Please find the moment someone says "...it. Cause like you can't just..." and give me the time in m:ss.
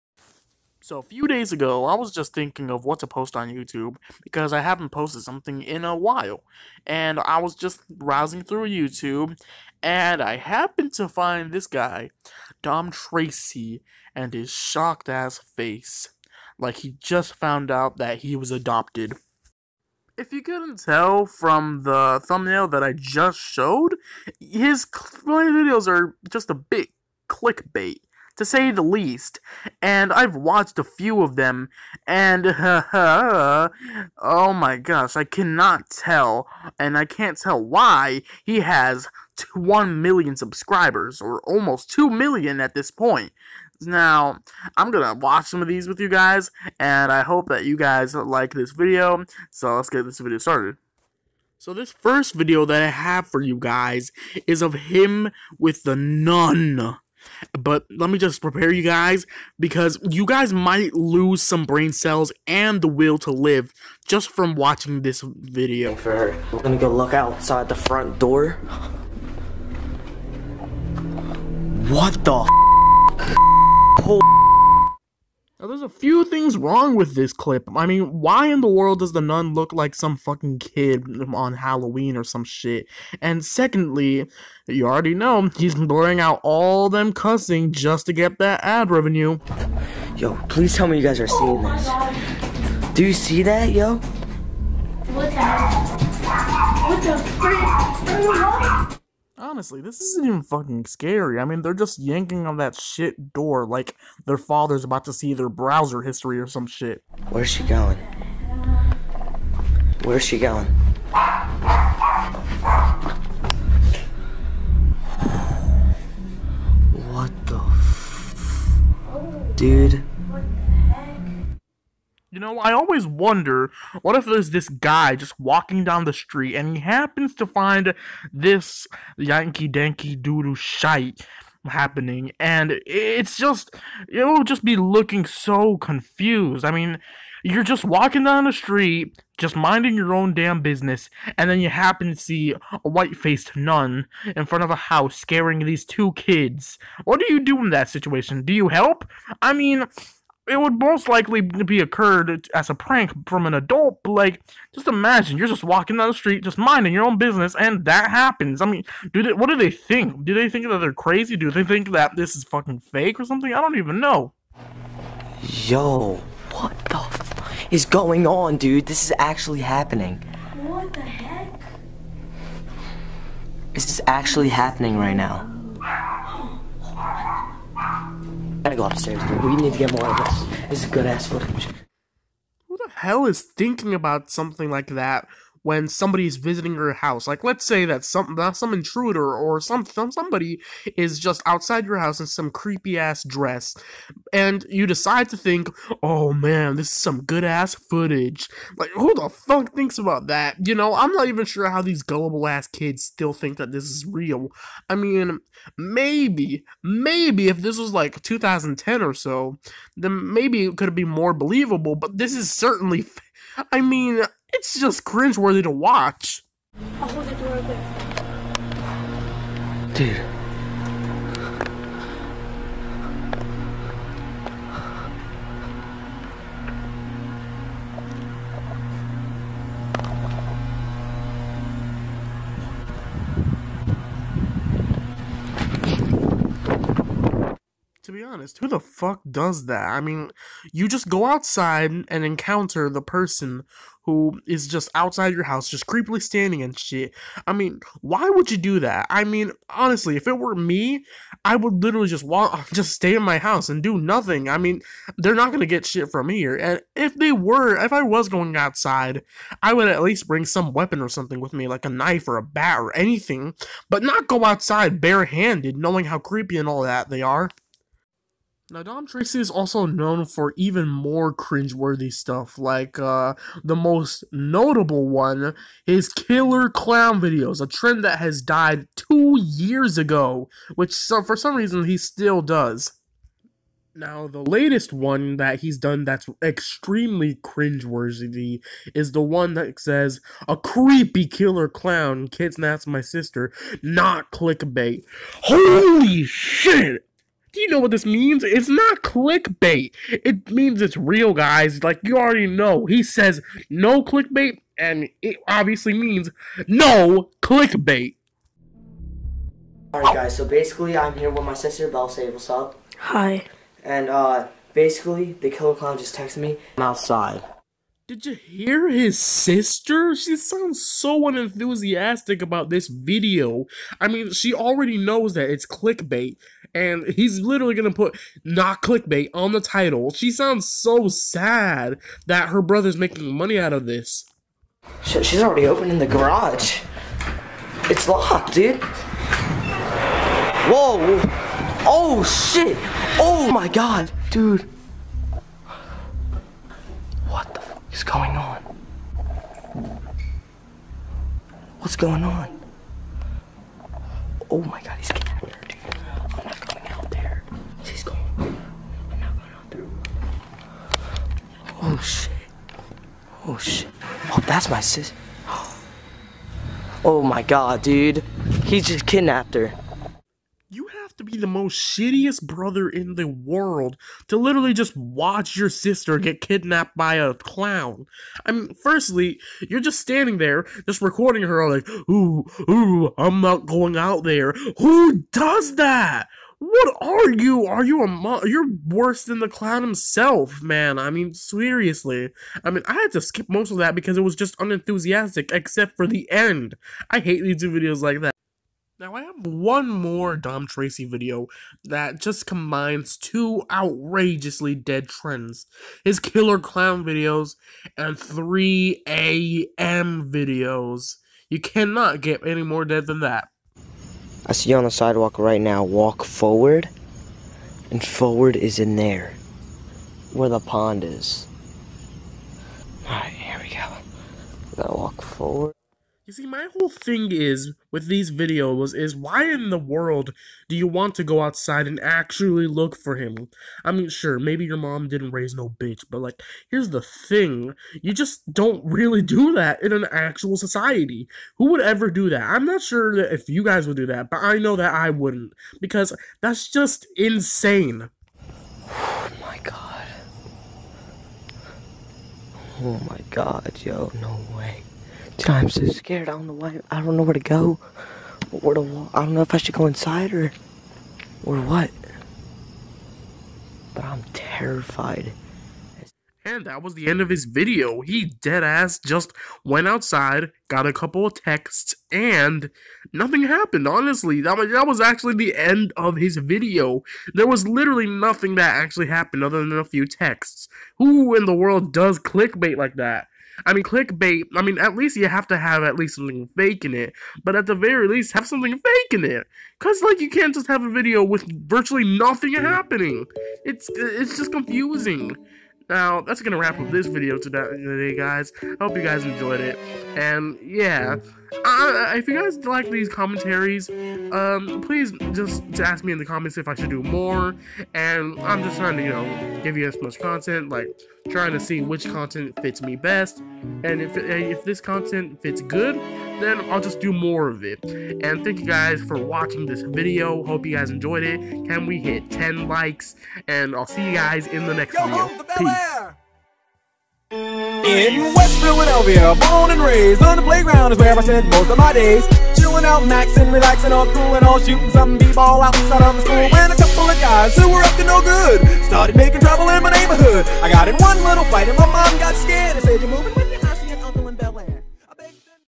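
8:09.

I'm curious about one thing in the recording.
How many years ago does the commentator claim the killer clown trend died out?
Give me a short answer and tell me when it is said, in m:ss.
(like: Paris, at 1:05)
Two years, at 4:38.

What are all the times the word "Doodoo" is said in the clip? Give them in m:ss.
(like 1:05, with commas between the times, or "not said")
2:10.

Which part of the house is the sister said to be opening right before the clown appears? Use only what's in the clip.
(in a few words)
The garage.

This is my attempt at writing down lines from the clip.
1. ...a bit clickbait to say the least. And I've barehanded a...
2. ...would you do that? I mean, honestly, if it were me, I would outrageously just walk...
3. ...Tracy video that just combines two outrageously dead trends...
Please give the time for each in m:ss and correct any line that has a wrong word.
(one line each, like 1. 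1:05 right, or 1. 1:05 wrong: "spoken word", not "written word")
1. 0:26 wrong: "watched", not "barehanded"
2. 4:08 wrong: "literally", not "outrageously"
3. 6:40 right.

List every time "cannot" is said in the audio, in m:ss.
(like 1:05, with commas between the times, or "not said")
0:35, 6:51.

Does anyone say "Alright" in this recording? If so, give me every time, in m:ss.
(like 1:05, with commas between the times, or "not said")
5:09, 7:03.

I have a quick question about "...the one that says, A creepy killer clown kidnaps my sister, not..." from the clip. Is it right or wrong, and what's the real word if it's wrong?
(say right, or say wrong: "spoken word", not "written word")
right.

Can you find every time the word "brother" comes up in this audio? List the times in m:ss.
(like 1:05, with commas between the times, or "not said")
5:32, 6:12.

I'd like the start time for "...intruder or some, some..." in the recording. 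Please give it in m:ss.
3:08.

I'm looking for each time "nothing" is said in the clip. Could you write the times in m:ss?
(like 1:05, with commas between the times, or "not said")
4:13, 7:53, 7:58, 8:12.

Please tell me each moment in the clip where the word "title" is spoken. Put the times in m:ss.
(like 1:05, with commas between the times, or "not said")
5:29.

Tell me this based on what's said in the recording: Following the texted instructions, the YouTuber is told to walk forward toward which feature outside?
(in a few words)
The pond.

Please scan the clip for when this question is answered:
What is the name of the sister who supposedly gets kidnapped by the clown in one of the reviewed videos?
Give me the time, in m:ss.
5:11.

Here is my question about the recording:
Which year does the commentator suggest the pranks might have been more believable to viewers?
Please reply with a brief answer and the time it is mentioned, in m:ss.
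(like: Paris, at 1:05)
2010, at 3:28.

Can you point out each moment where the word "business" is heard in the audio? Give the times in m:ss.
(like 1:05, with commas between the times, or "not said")
2:20, 2:37.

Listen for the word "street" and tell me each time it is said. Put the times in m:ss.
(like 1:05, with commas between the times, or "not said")
2:06, 2:18, 2:36.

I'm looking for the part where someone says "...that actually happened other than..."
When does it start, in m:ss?
7:58.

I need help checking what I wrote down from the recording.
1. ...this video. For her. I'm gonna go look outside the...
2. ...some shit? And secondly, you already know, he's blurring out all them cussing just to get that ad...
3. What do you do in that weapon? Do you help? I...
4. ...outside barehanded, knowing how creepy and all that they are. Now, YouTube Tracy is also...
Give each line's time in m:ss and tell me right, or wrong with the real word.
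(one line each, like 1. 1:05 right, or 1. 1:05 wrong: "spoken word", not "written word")
1. 1:05 right
2. 1:22 right
3. 2:27 wrong: "situation", not "weapon"
4. 4:24 wrong: "Dom", not "YouTube".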